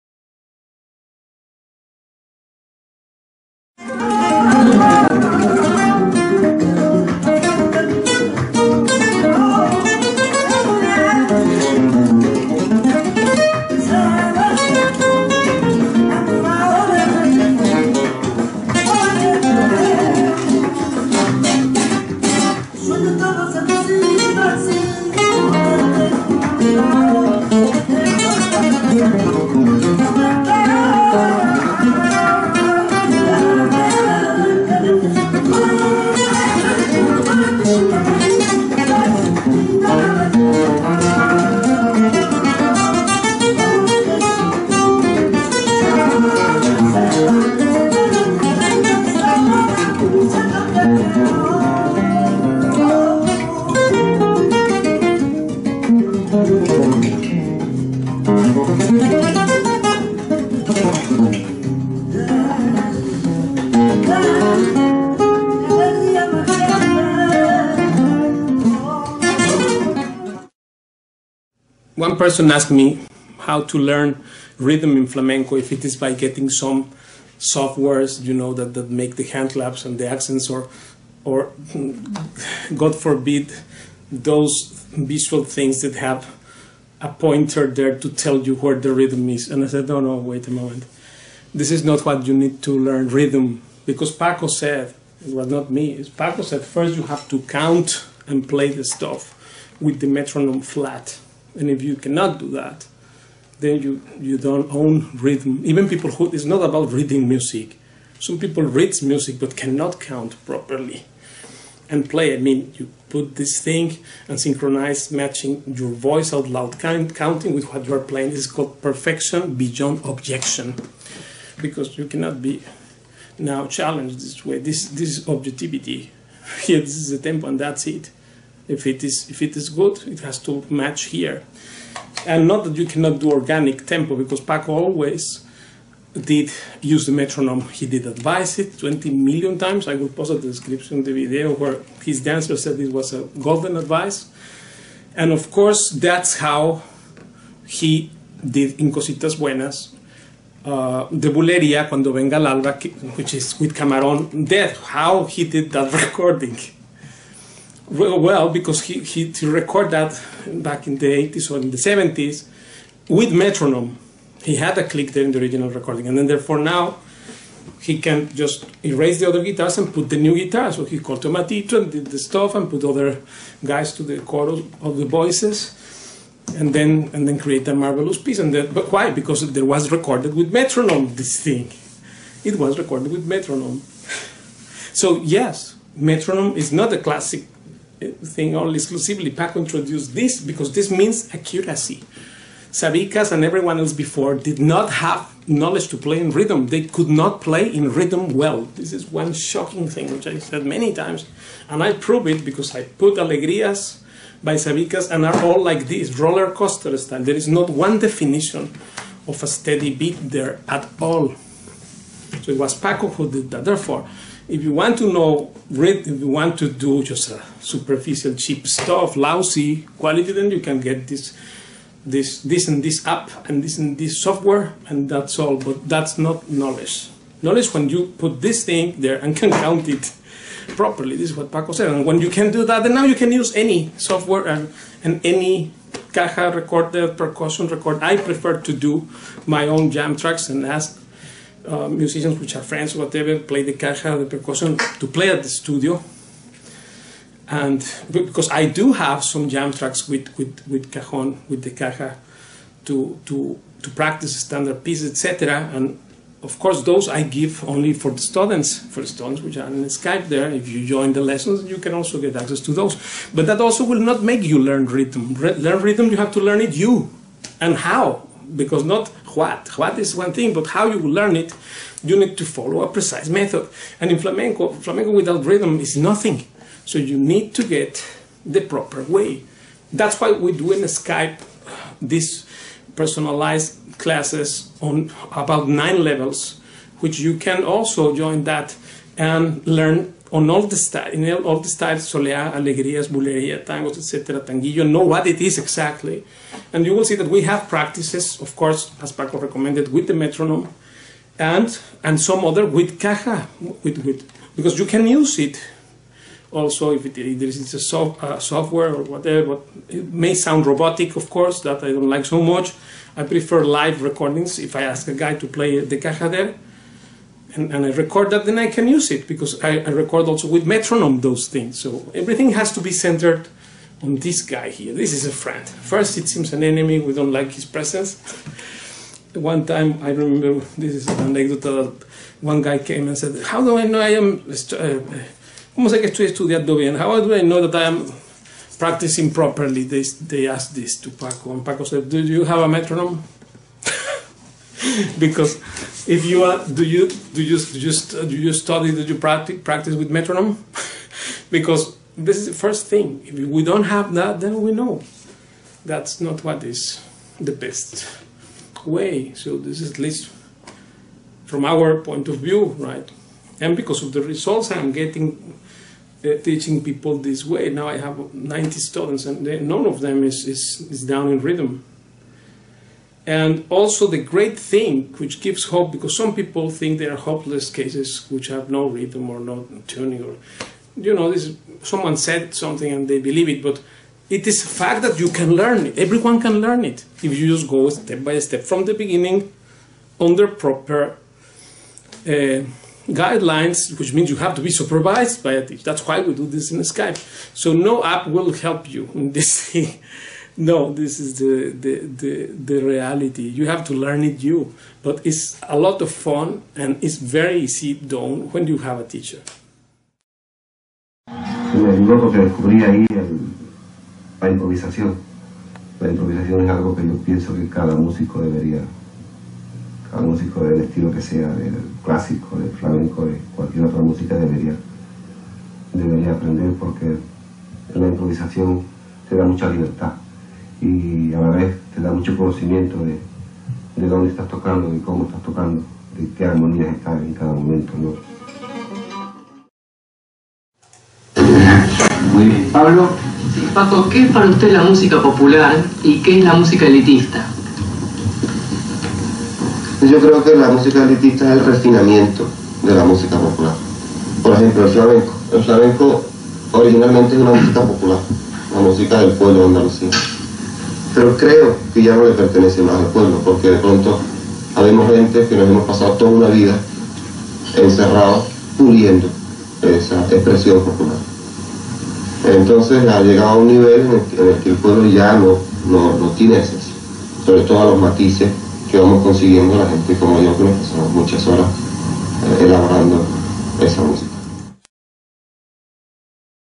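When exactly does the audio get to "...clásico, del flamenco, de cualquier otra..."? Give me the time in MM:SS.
07:02.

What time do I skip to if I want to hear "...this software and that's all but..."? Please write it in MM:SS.
03:43.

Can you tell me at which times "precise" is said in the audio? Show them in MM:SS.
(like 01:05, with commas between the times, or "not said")
04:32.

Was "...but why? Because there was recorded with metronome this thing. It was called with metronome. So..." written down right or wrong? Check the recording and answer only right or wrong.
wrong.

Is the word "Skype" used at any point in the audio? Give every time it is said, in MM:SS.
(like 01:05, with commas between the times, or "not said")
04:19, 04:40, 06:36.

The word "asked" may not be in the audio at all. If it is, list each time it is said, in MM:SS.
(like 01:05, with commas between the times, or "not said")
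01:12, 05:40.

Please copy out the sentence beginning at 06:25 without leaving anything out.
Everyone can learn it if you just go step by step from the beginning under proper.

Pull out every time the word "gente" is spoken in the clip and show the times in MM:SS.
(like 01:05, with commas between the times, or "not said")
07:45, 07:59.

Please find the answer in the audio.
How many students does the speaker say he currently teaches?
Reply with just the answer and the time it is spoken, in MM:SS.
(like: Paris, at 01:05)
90, at 06:08.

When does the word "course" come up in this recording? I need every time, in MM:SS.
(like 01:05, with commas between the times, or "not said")
02:25, 04:16, 04:58, 05:11.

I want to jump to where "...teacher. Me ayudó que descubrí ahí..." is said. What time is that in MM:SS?
06:49.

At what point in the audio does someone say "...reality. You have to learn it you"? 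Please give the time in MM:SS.
06:42.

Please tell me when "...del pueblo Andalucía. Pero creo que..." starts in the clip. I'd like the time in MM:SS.
07:39.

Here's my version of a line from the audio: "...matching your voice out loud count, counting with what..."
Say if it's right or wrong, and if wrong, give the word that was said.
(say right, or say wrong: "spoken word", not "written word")
right.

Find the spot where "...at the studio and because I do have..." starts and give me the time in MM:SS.
04:05.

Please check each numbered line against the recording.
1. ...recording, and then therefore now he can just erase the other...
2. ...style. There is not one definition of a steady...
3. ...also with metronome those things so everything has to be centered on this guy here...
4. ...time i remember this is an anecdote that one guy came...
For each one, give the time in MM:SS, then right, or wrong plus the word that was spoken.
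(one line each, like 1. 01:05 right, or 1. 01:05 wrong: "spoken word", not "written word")
1. 02:45 right
2. 03:26 right
3. 05:20 right
4. 05:29 right.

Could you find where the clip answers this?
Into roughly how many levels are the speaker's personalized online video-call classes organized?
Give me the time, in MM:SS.
04:45.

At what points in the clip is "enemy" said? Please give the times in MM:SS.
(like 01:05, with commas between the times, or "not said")
05:26.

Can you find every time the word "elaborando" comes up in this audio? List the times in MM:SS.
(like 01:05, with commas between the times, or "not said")
08:02.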